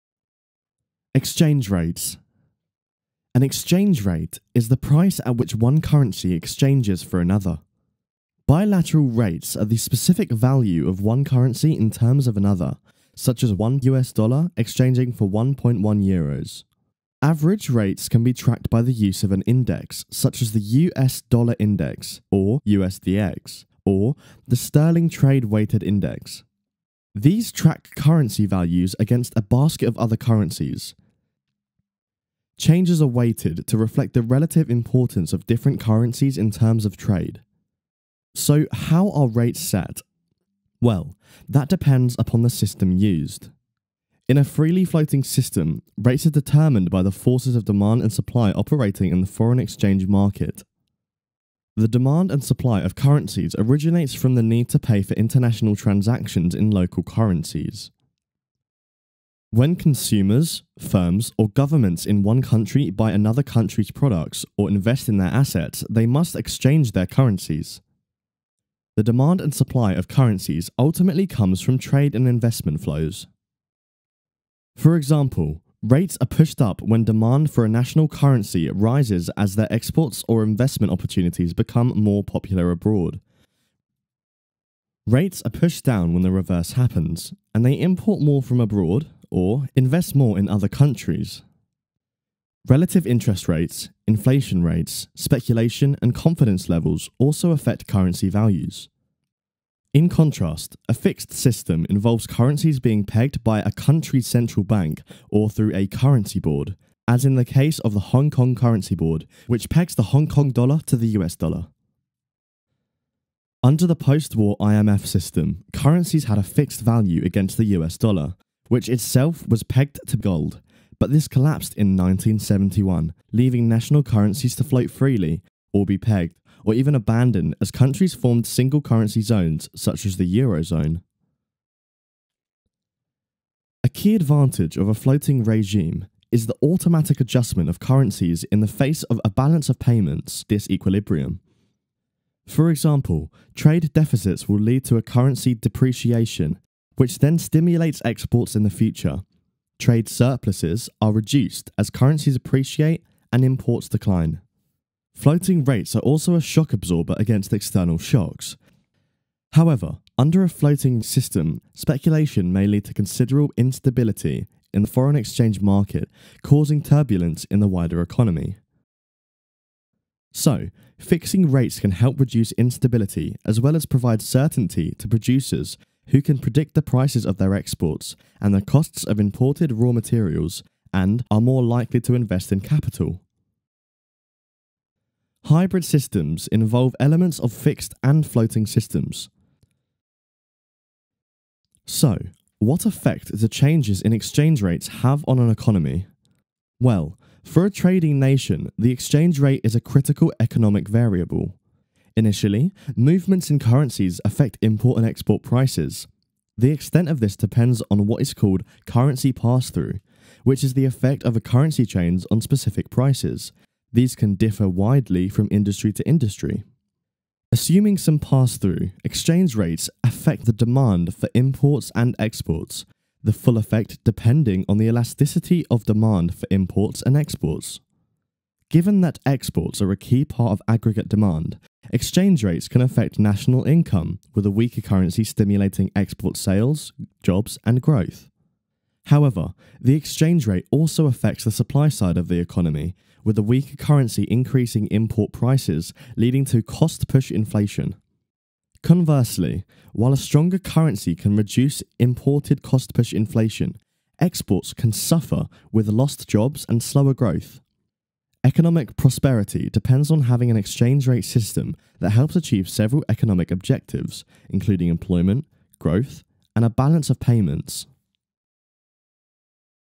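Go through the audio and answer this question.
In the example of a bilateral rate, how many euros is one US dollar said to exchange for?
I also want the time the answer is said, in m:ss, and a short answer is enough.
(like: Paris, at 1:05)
1.1 euros, at 0:15.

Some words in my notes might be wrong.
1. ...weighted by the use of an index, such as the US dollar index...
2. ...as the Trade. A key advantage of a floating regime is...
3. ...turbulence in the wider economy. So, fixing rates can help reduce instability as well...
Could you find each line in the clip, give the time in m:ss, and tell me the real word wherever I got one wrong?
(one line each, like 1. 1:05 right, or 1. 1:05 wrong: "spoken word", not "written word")
1. 0:18 wrong: "tracked", not "weighted"
2. 2:10 wrong: "Eurozone", not "Trade"
3. 2:46 right.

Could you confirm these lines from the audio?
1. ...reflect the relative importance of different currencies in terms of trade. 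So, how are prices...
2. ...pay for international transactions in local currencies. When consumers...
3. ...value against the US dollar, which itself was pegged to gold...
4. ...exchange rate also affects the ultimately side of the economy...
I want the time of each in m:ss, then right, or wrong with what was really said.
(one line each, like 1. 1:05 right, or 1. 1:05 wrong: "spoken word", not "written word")
1. 0:33 wrong: "rates", not "prices"
2. 0:54 right
3. 1:56 right
4. 3:59 wrong: "supply", not "ultimately".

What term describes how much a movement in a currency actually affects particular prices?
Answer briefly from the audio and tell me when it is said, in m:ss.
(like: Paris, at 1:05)
currency pass through, at 3:28.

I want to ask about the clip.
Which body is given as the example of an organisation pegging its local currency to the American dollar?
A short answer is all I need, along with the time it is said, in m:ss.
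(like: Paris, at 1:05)
Hong Kong Currency Board, at 1:48.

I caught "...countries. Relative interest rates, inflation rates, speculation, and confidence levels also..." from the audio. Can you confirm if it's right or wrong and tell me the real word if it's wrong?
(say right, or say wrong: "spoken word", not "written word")
right.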